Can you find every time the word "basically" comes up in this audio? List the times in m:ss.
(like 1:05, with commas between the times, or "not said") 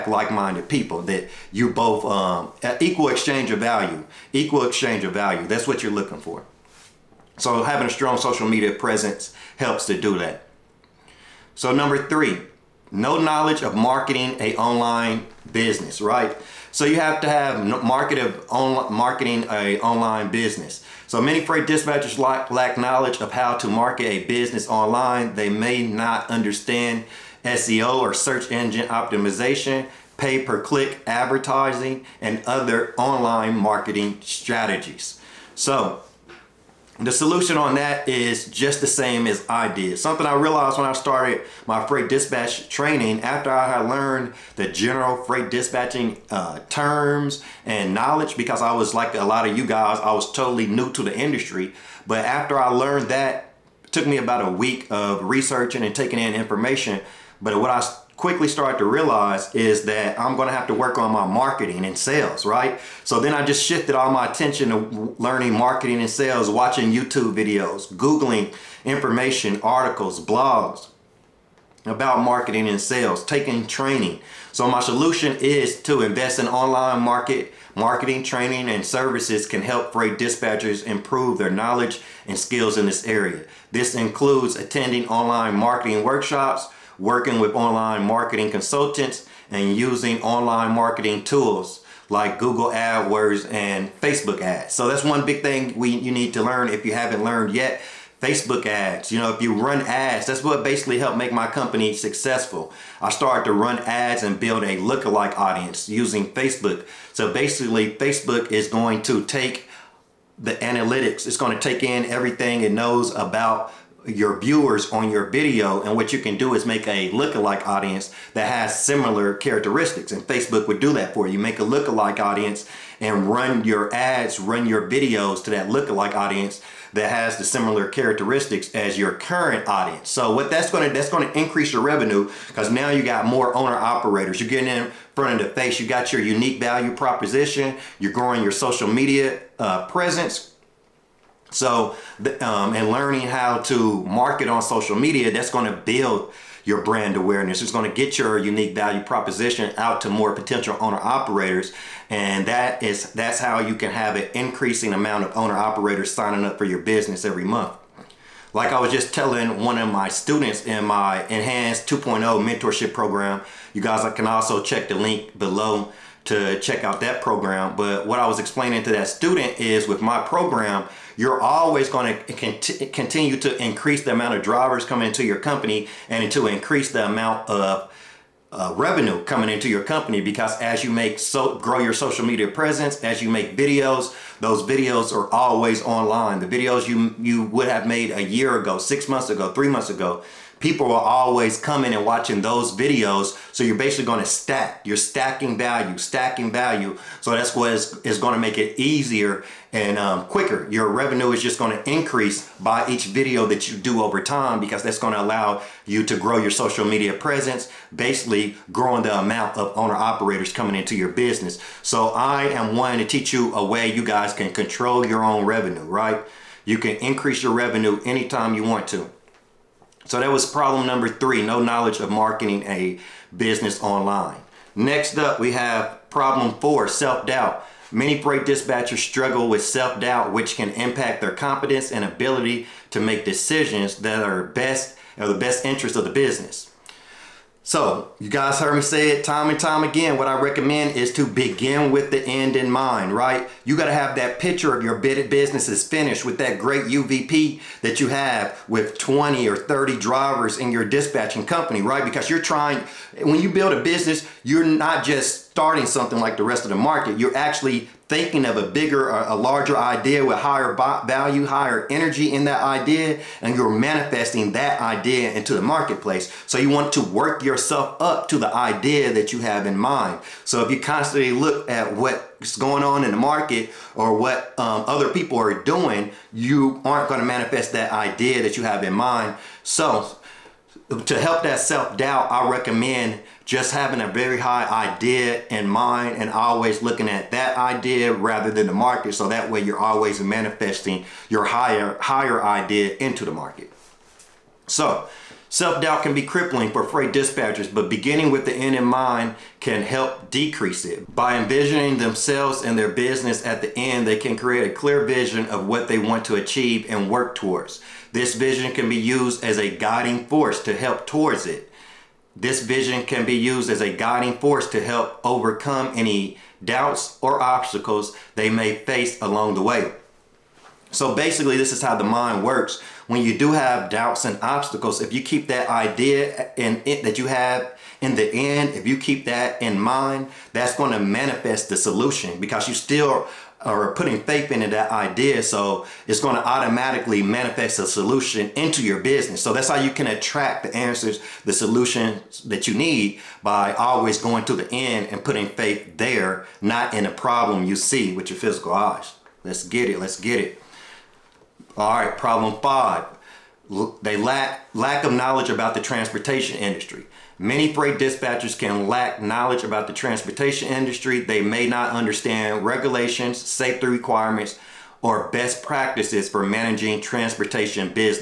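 1:40, 1:47, 3:13, 3:27, 5:21.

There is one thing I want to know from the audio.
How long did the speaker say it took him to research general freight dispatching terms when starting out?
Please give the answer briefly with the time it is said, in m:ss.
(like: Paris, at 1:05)
about a week, at 0:54.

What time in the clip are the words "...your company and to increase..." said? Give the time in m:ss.
2:55.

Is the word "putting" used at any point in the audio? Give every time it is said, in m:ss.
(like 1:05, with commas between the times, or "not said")
5:33, 5:45.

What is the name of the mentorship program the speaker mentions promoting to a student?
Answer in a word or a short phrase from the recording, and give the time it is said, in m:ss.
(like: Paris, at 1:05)
Enhanced 2.0, at 2:41.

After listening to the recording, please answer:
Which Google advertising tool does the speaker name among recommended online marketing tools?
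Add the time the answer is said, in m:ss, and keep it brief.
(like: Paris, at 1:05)
Google AdWords, at 1:32.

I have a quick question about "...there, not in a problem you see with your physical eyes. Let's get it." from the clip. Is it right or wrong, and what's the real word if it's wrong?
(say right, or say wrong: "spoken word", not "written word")
right.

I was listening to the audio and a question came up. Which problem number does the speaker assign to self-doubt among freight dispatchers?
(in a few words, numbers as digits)
4.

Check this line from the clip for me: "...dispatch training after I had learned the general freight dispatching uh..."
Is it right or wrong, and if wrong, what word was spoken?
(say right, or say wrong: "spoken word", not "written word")
right.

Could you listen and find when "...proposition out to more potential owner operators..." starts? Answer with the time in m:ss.
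2:29.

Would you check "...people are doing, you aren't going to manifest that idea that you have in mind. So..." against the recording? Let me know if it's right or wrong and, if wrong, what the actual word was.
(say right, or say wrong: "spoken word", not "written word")
right.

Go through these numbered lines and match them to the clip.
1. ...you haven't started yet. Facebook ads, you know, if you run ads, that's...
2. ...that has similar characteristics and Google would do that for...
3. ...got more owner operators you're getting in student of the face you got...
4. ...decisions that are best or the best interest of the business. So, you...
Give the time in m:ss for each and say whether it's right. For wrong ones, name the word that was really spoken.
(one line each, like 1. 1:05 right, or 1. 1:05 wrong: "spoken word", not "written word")
1. 1:36 wrong: "learned", not "started"
2. 1:58 wrong: "Facebook", not "Google"
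3. 2:13 wrong: "front", not "student"
4. 3:53 right.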